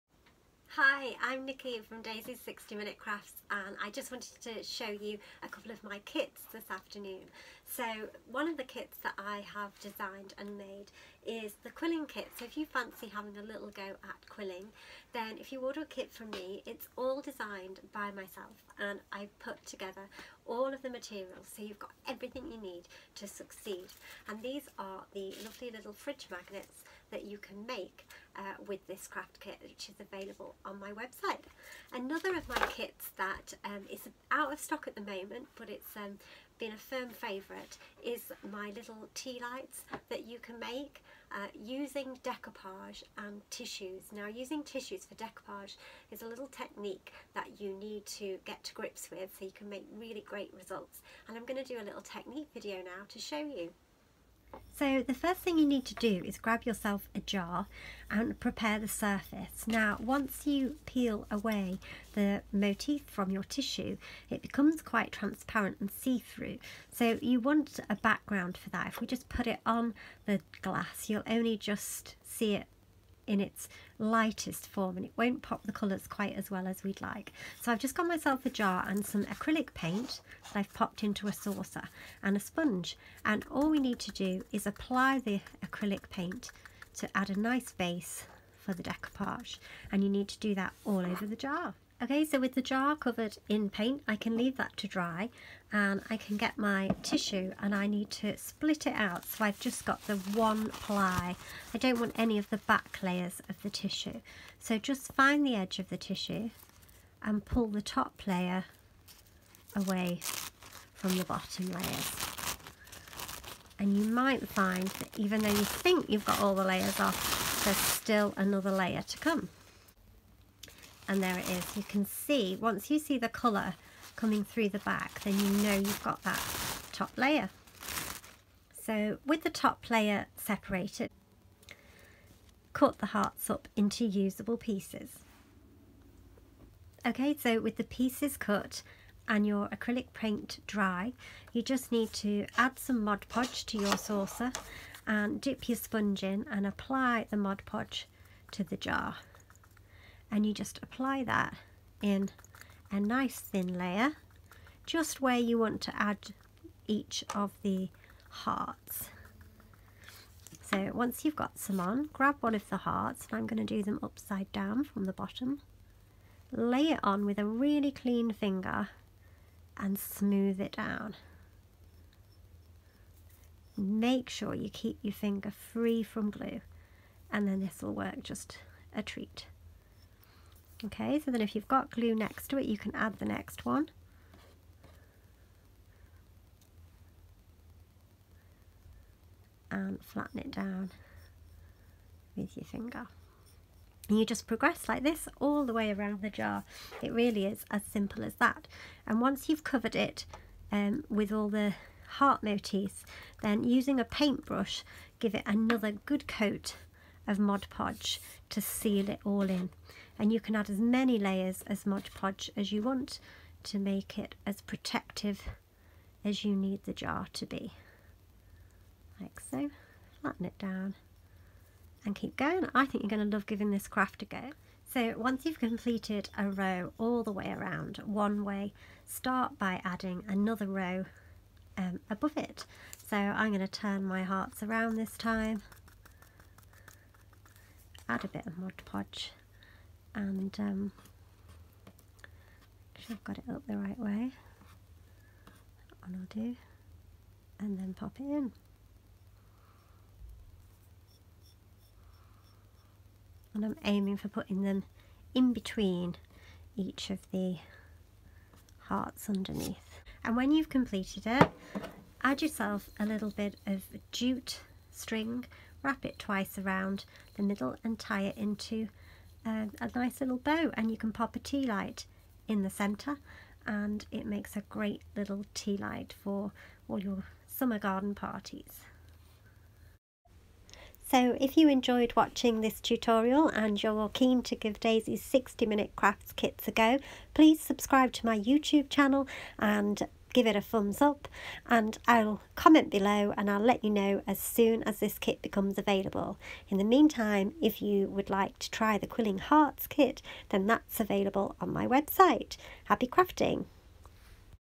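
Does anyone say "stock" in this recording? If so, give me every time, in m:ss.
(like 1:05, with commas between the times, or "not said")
0:34.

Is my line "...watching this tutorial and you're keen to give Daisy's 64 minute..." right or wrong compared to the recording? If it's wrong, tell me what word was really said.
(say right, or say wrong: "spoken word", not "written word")
wrong: "60", not "64".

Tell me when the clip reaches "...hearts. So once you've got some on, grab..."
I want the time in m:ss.
2:38.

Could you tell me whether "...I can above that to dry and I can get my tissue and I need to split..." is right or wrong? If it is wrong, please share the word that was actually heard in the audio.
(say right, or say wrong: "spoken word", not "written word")
wrong: "leave", not "above".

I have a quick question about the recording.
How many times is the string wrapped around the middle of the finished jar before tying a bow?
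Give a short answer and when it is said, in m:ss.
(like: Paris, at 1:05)
2, at 4:26.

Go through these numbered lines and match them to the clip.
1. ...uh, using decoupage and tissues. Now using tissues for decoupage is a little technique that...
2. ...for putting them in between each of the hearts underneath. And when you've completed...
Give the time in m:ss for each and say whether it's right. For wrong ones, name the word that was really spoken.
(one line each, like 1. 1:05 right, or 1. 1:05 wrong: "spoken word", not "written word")
1. 0:41 right
2. 4:14 right.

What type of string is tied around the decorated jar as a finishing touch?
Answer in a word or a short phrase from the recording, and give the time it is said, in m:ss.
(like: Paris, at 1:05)
Jute string, at 4:24.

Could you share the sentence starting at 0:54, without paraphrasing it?
So the first thing you need to do is grab yourself a jar and prepare the surface.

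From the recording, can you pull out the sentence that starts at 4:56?
In the meantime, if you would like to try the Quilling Hearts kit, then that's available on my website.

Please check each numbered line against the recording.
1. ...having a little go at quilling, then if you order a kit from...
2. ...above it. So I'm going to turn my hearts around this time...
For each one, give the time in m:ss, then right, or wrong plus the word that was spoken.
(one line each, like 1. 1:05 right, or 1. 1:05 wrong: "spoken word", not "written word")
1. 0:13 right
2. 3:52 right.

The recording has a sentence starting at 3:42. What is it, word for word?
I think you're going to love giving this craft a go.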